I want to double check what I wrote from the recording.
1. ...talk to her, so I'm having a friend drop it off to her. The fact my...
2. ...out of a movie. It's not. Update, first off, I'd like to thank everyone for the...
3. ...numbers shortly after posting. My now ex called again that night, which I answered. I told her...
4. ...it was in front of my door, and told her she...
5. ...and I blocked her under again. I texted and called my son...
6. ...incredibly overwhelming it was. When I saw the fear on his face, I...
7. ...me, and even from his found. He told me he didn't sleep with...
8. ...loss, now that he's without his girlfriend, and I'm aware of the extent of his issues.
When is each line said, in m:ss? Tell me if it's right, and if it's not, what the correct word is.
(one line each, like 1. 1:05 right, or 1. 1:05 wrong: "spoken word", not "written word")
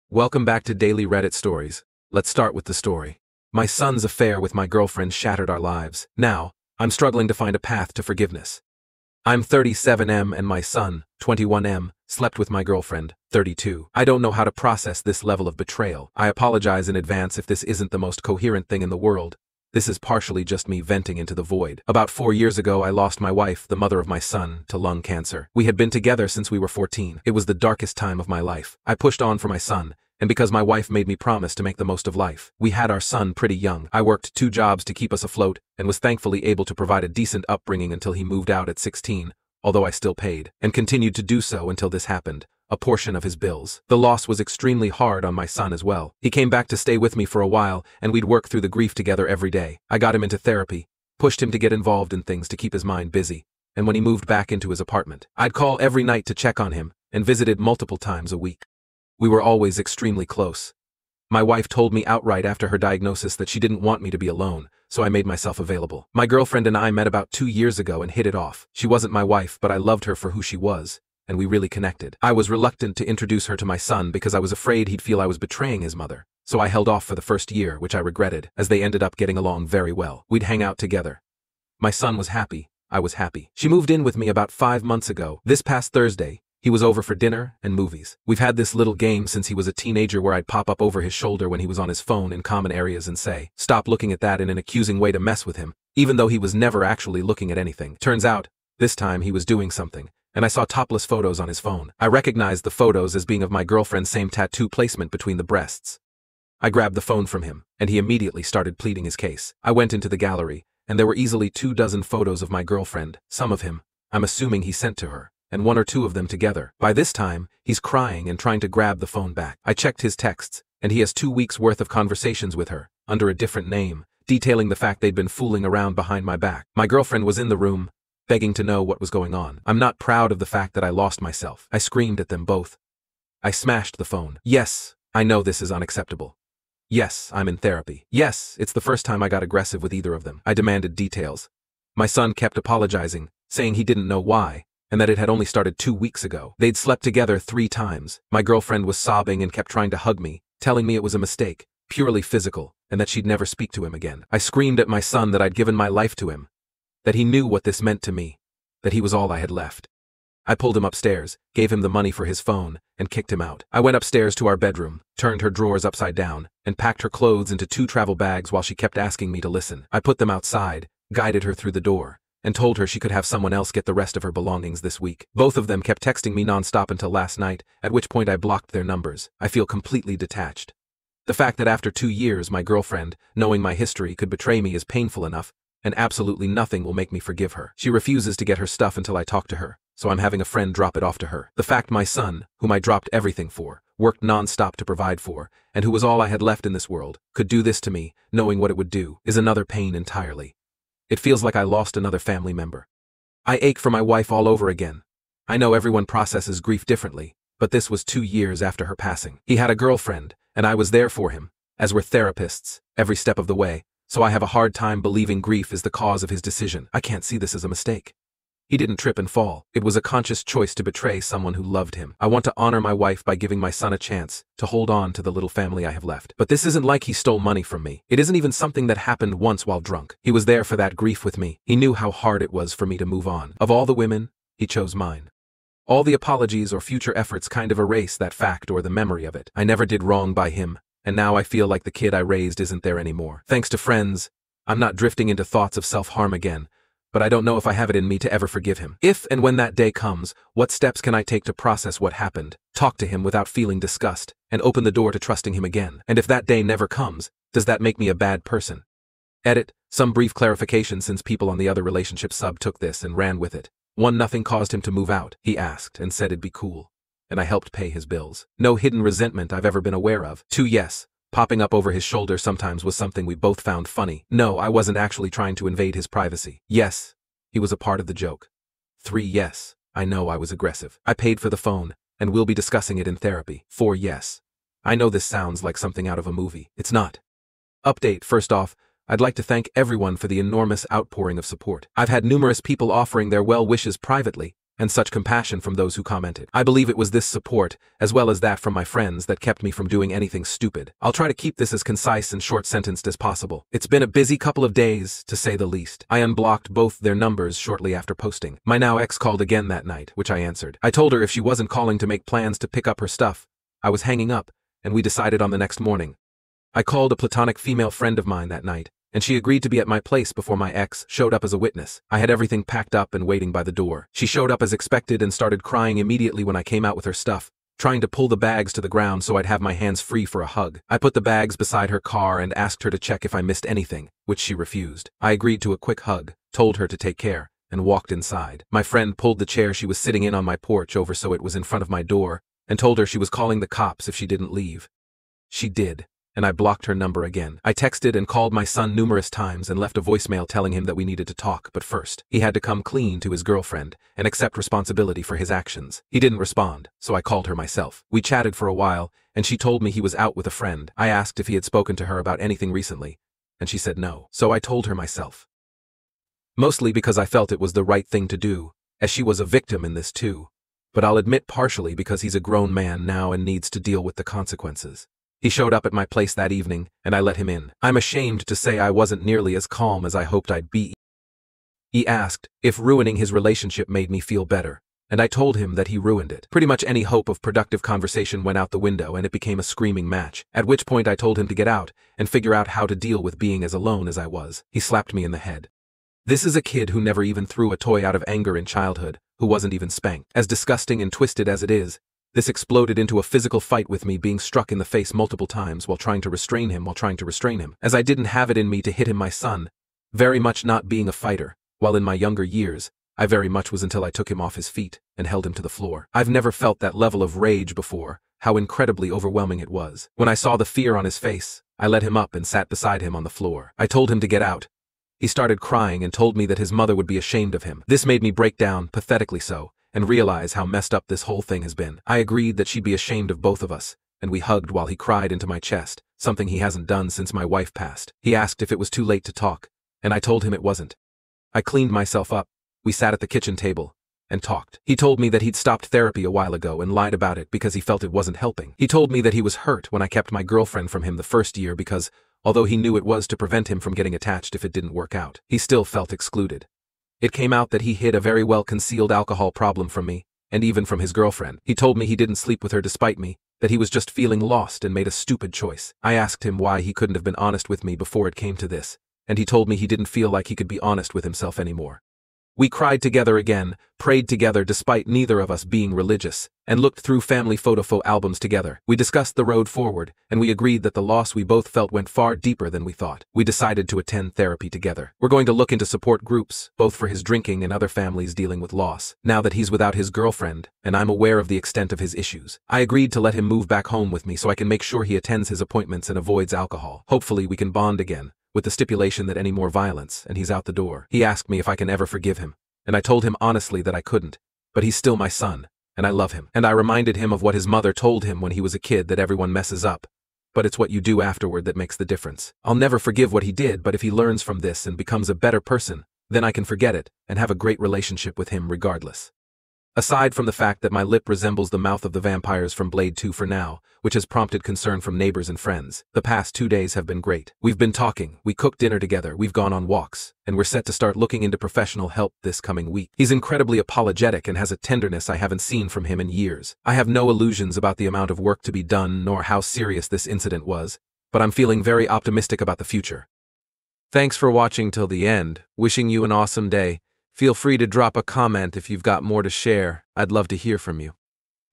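1. 3:09 right
2. 4:46 right
3. 5:07 right
4. 5:41 right
5. 5:46 wrong: "number", not "under"
6. 6:58 right
7. 7:40 wrong: "girlfriend", not "found"
8. 8:08 right.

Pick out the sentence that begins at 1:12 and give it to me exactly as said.
I was reluctant to introduce her to my son because I was afraid he'd feel I was betraying his mother.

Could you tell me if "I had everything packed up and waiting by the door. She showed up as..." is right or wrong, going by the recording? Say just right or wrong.
right.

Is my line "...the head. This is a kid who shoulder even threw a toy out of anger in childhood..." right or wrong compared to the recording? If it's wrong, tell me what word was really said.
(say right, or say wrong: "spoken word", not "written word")
wrong: "never", not "shoulder".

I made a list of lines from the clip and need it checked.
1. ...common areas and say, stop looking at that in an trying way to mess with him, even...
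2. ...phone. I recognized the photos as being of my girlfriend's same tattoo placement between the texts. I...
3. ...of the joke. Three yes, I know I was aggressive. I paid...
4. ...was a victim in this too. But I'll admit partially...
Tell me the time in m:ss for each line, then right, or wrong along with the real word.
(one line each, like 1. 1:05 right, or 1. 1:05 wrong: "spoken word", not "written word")
1. 1:32 wrong: "accusing", not "trying"
2. 1:41 wrong: "breasts", not "texts"
3. 4:38 right
4. 6:09 right.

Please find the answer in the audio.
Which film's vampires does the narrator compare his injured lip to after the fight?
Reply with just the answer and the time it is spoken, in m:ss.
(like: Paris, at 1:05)
Blade 2, at 8:42.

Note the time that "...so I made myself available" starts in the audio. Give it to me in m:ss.
1:04.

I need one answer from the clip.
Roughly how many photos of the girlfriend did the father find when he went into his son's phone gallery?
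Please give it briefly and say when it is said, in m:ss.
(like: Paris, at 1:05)
2 dozen, at 1:51.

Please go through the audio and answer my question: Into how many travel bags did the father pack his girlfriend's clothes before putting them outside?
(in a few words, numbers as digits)
2.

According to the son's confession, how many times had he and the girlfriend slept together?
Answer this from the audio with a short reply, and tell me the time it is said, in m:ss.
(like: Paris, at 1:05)
3, at 2:27.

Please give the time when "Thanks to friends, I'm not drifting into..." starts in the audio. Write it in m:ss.
4:03.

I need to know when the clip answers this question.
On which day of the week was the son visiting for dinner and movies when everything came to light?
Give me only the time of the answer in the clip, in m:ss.
1:25.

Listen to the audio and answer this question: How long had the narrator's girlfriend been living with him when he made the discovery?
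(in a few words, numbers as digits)
5 months.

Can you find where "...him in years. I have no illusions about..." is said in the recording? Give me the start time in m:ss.
8:56.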